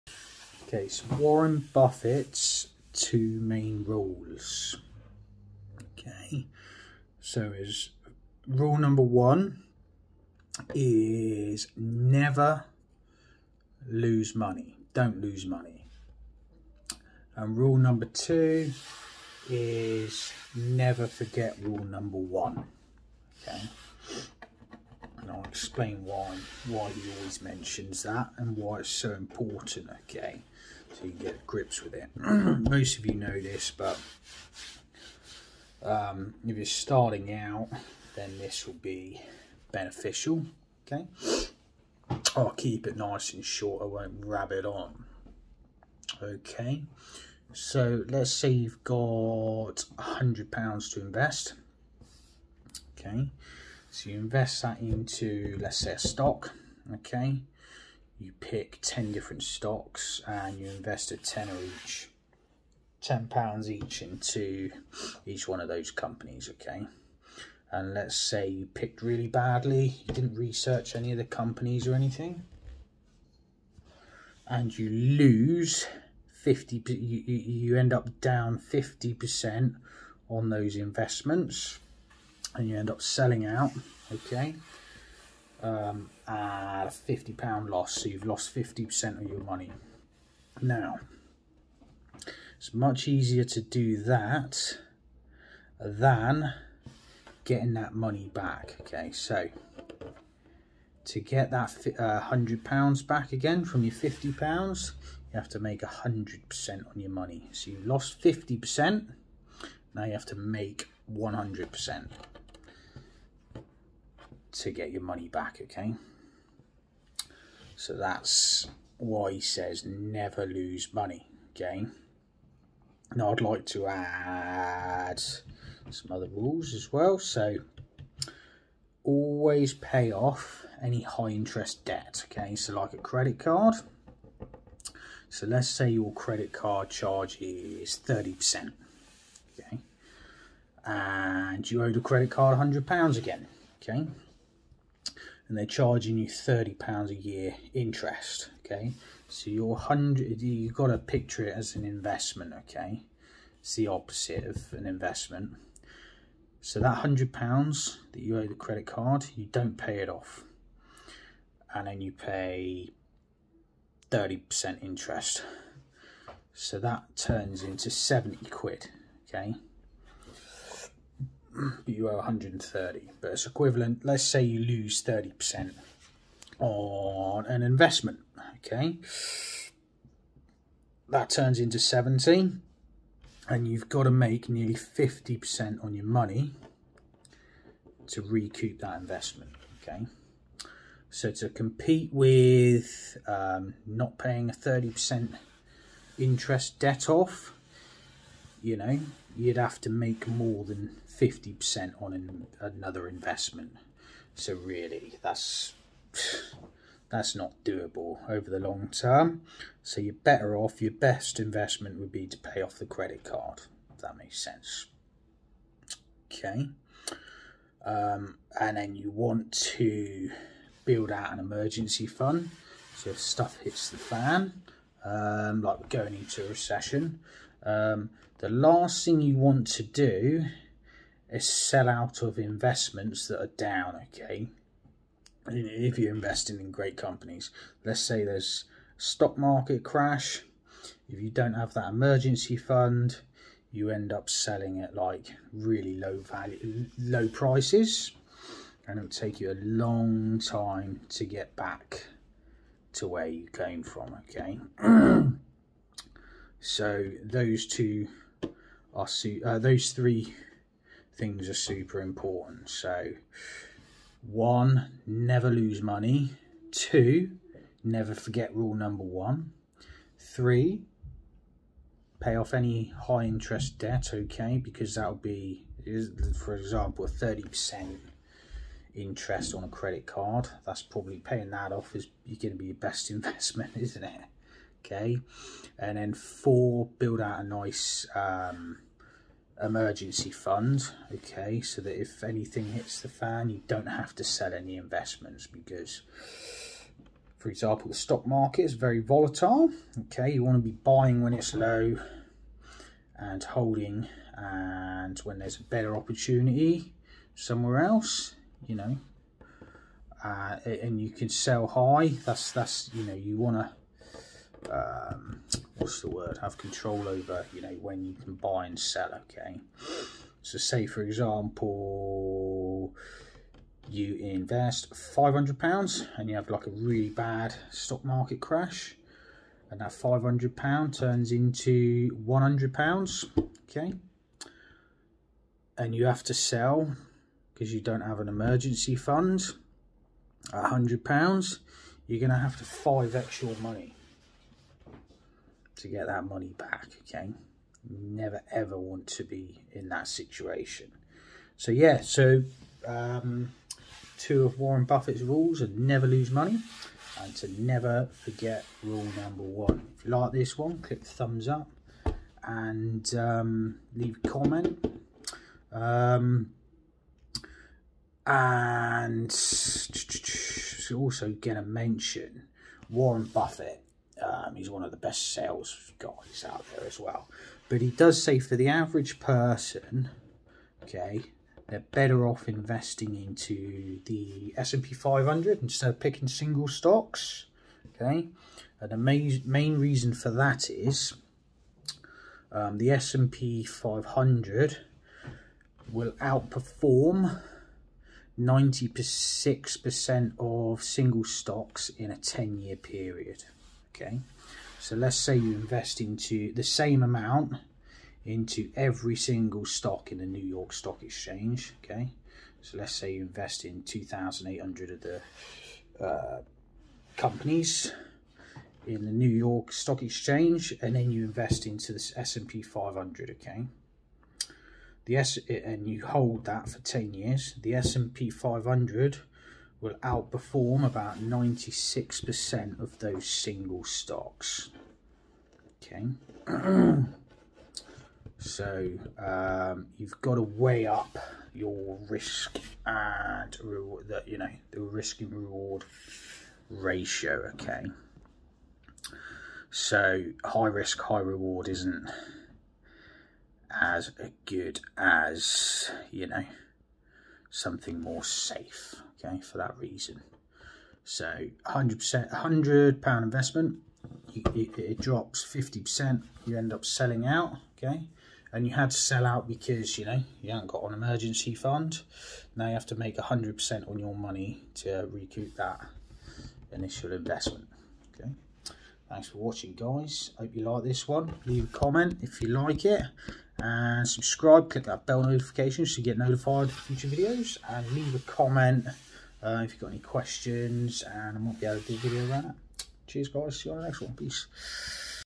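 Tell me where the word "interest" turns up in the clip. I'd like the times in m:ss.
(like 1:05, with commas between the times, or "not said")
2:11, 2:27, 2:44, 3:16, 4:33, 4:38.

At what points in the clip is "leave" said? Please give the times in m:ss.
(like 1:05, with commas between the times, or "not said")
6:03, 8:01, 8:07.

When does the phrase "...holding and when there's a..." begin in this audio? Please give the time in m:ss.
5:03.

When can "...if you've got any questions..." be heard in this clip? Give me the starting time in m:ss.
8:09.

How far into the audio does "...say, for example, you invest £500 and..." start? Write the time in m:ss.
5:20.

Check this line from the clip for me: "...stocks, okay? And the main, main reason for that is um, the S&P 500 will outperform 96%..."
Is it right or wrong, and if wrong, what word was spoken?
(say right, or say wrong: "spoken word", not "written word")
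right.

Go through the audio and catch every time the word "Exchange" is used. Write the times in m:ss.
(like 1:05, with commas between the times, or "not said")
6:51, 7:00.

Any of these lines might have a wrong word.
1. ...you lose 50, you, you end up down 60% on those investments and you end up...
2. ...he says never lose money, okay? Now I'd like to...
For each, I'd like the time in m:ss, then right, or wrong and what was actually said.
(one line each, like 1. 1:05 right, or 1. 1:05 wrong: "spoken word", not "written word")
1. 1:14 wrong: "50", not "60"
2. 1:59 right.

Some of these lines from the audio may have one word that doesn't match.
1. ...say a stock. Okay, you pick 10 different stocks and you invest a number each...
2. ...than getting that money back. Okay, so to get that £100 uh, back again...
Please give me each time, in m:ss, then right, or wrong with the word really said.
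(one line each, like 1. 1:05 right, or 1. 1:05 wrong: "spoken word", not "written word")
1. 0:55 wrong: "tenner", not "number"
2. 1:35 right.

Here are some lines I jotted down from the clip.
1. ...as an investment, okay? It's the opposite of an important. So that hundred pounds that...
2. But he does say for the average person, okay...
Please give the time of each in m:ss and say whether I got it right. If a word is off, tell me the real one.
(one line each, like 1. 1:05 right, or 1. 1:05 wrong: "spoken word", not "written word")
1. 2:31 wrong: "investment", not "important"
2. 6:17 right.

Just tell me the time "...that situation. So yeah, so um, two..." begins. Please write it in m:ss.
5:49.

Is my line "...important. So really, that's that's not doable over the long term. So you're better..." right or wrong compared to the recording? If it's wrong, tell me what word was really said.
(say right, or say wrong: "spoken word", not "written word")
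wrong: "investment", not "important".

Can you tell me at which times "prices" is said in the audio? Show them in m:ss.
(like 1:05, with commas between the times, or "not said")
4:07.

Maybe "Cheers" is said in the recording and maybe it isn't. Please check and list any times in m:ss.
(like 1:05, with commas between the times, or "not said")
8:13.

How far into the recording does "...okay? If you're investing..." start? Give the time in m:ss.
3:54.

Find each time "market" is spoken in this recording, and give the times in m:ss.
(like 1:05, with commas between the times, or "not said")
3:59, 4:58, 5:28.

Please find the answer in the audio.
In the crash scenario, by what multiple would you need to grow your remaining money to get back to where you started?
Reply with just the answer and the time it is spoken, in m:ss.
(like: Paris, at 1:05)
5x, at 5:42.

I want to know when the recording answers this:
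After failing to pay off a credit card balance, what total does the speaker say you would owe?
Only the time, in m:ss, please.
2:52.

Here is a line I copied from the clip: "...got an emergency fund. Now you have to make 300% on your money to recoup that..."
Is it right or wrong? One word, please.
wrong.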